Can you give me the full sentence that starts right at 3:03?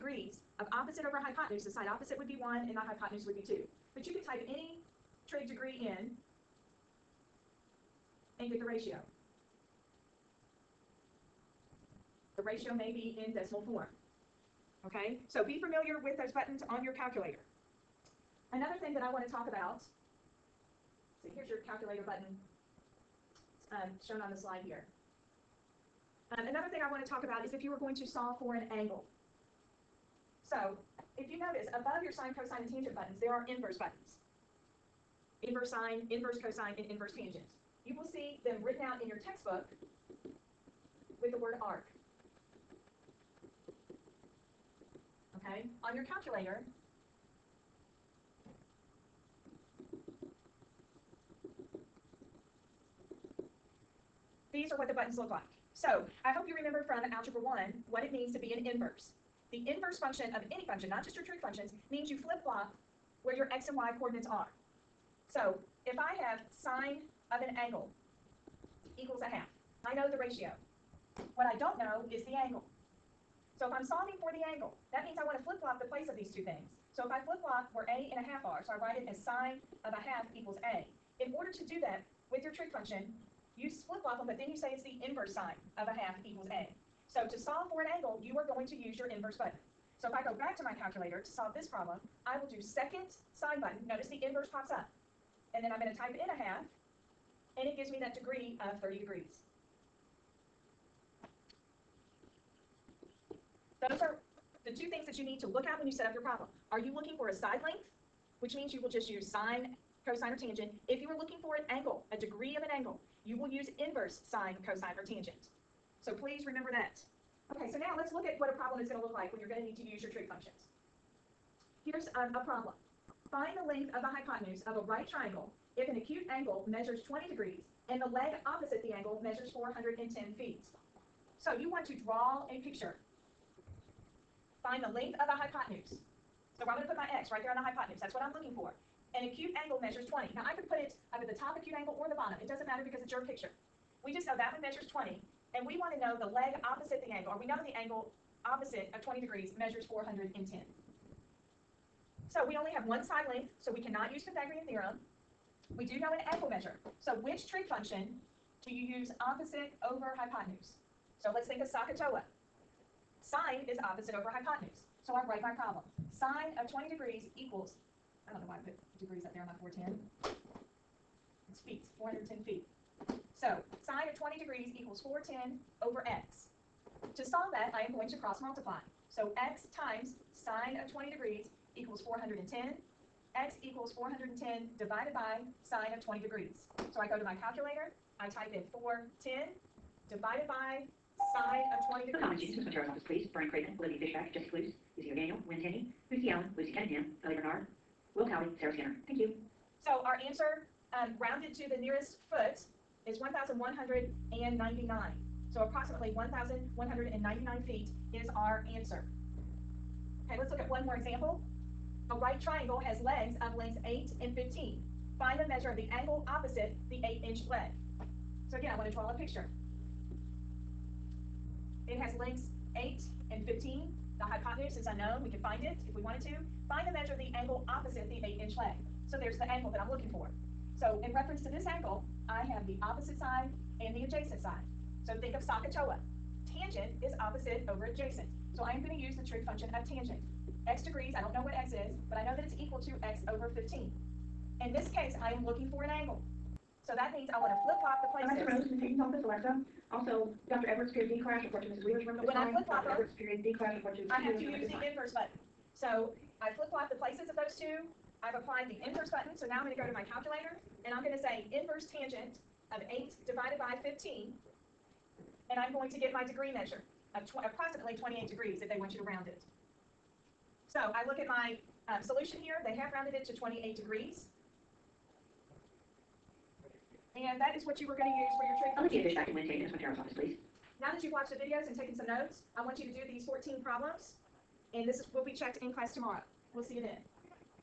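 x equals 410 divided by sine of 20 degrees.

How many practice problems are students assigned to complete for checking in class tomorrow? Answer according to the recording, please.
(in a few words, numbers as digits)
14.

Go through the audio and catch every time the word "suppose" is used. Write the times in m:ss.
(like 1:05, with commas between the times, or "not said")
not said.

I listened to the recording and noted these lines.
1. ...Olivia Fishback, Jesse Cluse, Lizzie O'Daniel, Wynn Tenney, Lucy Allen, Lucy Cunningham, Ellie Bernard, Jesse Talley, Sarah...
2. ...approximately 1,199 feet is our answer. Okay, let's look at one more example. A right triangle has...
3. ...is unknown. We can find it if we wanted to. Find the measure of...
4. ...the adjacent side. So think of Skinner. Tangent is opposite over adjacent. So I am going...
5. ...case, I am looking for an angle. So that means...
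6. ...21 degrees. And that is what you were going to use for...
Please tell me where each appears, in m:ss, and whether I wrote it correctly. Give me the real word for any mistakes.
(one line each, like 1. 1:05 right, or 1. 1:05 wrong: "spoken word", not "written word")
1. 3:13 wrong: "Will", not "Jesse"
2. 3:25 right
3. 3:44 right
4. 3:53 wrong: "SOHCAHTOA", not "Skinner"
5. 4:04 right
6. 4:33 wrong: "28", not "21".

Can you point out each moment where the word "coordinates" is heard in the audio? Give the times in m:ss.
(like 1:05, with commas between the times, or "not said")
1:03.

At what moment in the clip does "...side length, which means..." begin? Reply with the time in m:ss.
1:47.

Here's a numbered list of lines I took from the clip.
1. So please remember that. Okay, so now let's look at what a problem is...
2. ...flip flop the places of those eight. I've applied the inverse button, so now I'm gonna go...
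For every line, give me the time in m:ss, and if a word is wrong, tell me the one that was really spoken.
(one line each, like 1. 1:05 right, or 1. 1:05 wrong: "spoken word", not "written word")
1. 1:56 right
2. 4:16 wrong: "two", not "eight".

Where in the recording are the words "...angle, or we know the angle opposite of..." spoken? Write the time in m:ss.
2:27.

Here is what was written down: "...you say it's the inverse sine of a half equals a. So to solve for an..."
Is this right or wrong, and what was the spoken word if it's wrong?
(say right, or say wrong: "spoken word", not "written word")
right.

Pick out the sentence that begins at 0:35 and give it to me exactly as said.
Inverse sine, inverse cosine, and inverse tangent.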